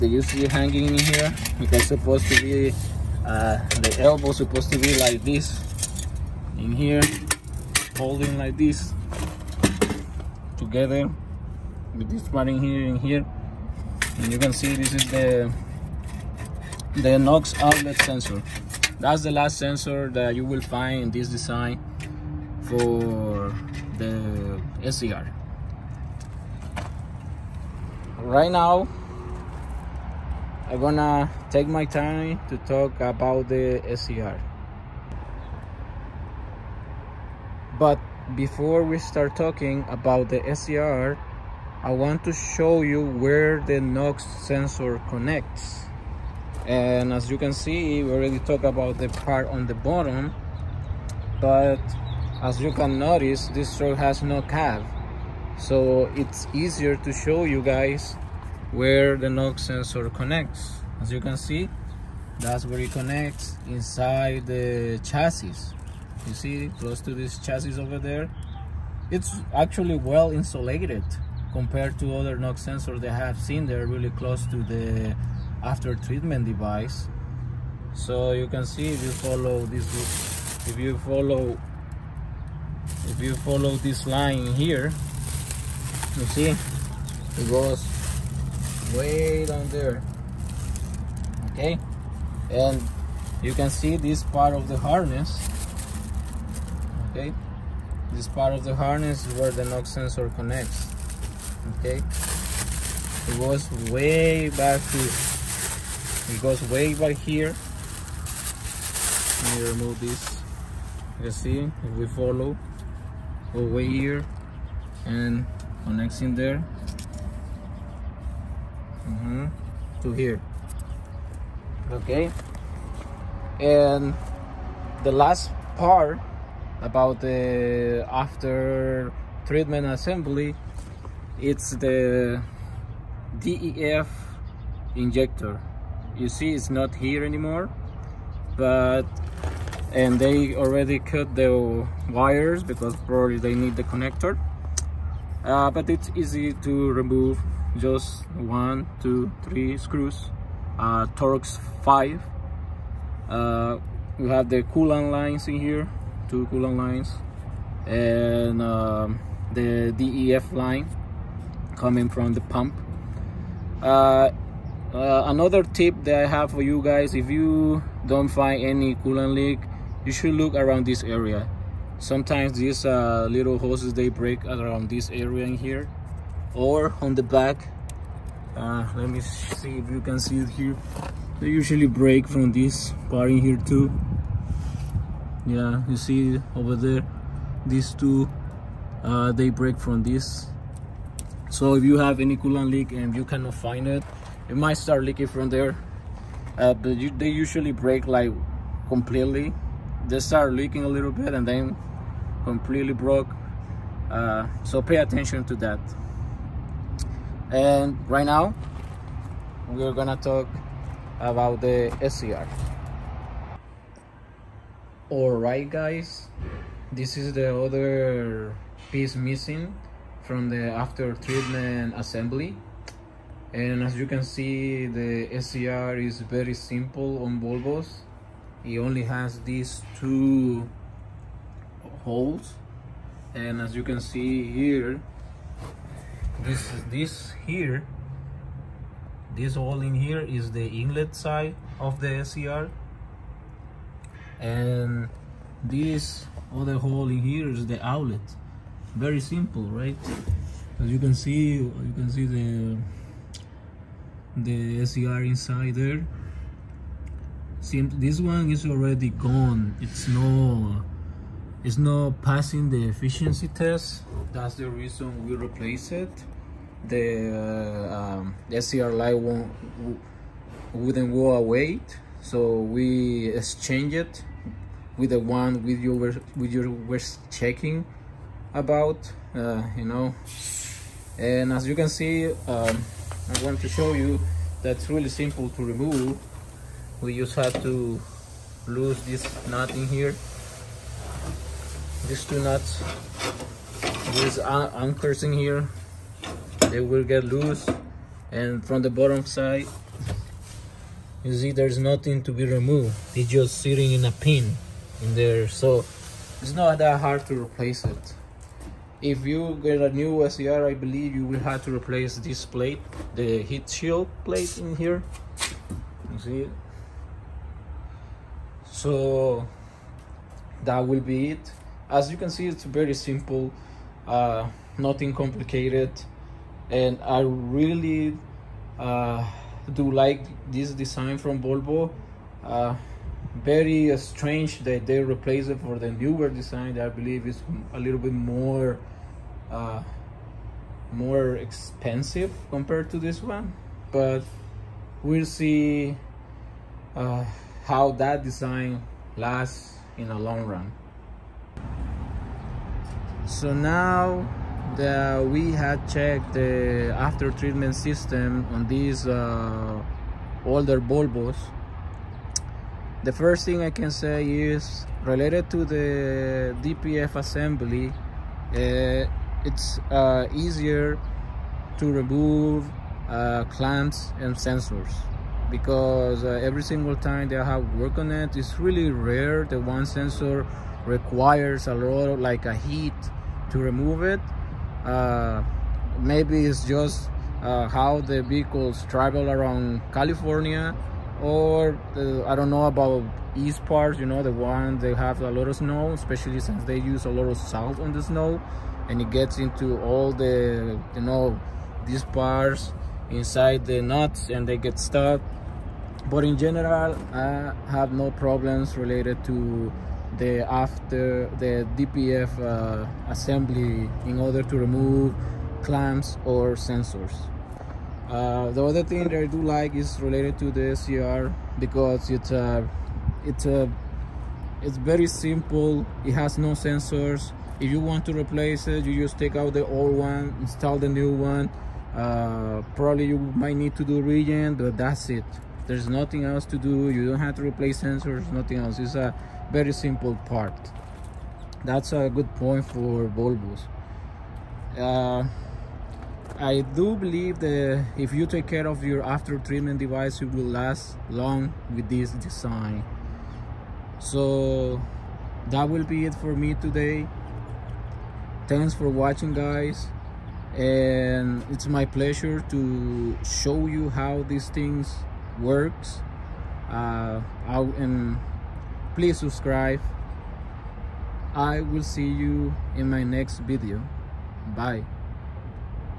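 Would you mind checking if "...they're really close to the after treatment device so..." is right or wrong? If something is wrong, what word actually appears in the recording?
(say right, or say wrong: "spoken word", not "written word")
right.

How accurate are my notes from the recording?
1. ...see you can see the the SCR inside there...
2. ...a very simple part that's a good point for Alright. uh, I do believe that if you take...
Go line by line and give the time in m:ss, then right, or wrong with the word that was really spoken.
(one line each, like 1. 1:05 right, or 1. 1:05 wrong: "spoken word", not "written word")
1. 4:11 right
2. 7:18 wrong: "Volvos", not "Alright".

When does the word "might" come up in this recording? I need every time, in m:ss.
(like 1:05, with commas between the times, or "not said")
3:14, 7:13.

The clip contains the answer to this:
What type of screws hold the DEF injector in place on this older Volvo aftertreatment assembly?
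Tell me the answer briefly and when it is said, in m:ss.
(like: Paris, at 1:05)
Torx 5, at 2:31.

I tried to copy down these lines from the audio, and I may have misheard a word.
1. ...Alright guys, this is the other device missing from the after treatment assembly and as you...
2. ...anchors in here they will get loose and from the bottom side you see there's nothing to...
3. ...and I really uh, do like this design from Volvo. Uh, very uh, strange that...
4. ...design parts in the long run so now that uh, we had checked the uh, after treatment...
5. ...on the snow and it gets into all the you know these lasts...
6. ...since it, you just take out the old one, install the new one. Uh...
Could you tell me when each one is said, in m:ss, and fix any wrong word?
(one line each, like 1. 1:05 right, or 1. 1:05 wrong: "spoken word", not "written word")
1. 3:35 wrong: "piece", not "device"
2. 4:54 right
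3. 5:26 right
4. 5:48 wrong: "lasts", not "parts"
5. 6:37 wrong: "parts", not "lasts"
6. 7:08 wrong: "replace", not "since".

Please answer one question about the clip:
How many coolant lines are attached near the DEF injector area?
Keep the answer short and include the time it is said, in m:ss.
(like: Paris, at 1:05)
2, at 2:36.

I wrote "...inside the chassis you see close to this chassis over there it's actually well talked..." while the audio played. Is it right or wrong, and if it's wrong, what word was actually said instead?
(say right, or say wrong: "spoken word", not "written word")
wrong: "insulated", not "talked".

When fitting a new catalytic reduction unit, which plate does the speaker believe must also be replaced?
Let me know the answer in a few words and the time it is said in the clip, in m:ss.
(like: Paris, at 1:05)
Heat shield plate, at 5:13.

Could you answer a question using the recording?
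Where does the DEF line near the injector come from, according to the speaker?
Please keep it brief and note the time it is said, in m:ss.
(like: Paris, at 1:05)
The pump, at 2:42.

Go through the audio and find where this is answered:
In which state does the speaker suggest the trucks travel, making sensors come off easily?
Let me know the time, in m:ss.
6:29.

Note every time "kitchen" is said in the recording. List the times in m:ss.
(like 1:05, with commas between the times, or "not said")
not said.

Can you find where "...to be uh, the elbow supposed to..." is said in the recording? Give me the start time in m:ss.
0:02.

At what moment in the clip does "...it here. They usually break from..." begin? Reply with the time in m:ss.
3:00.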